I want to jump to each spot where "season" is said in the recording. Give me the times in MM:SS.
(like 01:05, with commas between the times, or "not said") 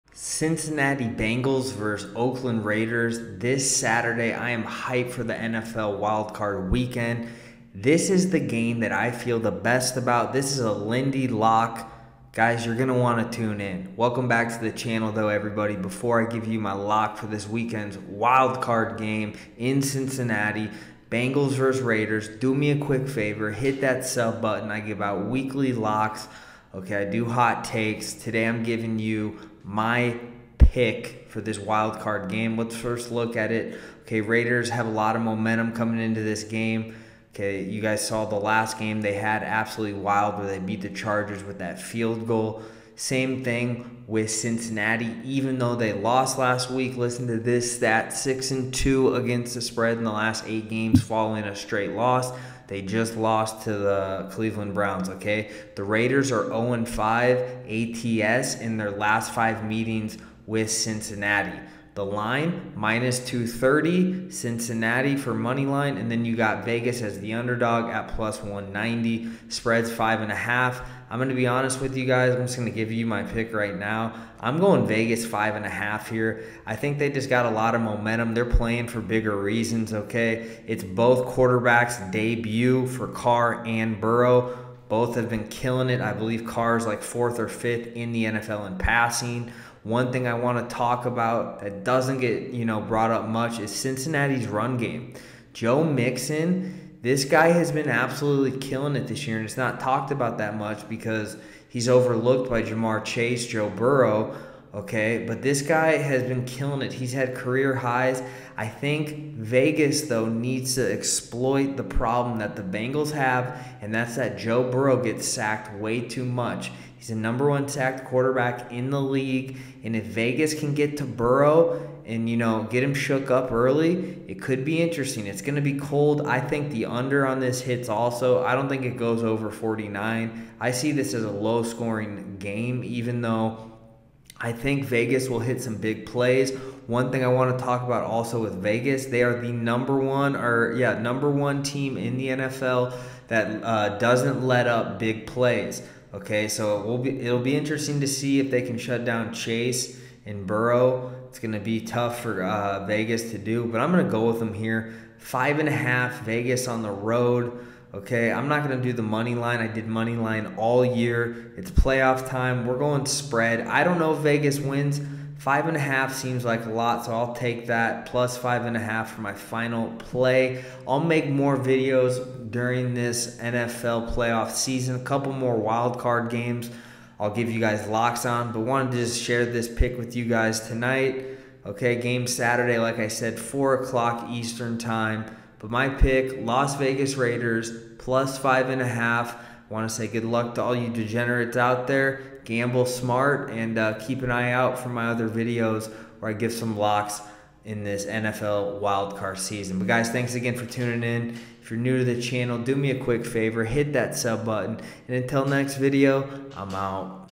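02:54, 03:19.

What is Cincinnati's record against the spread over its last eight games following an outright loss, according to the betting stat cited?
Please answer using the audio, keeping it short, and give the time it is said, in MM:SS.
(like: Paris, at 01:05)
6-2, at 00:48.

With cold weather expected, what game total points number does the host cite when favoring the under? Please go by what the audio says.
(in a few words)
49.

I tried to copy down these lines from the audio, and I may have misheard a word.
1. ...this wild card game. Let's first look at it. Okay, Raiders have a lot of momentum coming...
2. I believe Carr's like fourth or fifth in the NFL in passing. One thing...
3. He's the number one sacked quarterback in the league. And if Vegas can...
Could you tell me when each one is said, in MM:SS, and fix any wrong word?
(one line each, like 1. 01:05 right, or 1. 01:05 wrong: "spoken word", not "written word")
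1. 00:31 right
2. 01:26 right
3. 01:57 right.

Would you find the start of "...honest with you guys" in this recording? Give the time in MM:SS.
01:11.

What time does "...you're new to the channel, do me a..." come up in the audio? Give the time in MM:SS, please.
03:21.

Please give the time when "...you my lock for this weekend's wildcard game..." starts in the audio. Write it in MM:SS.
00:16.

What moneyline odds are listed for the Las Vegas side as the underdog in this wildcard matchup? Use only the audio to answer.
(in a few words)
+190.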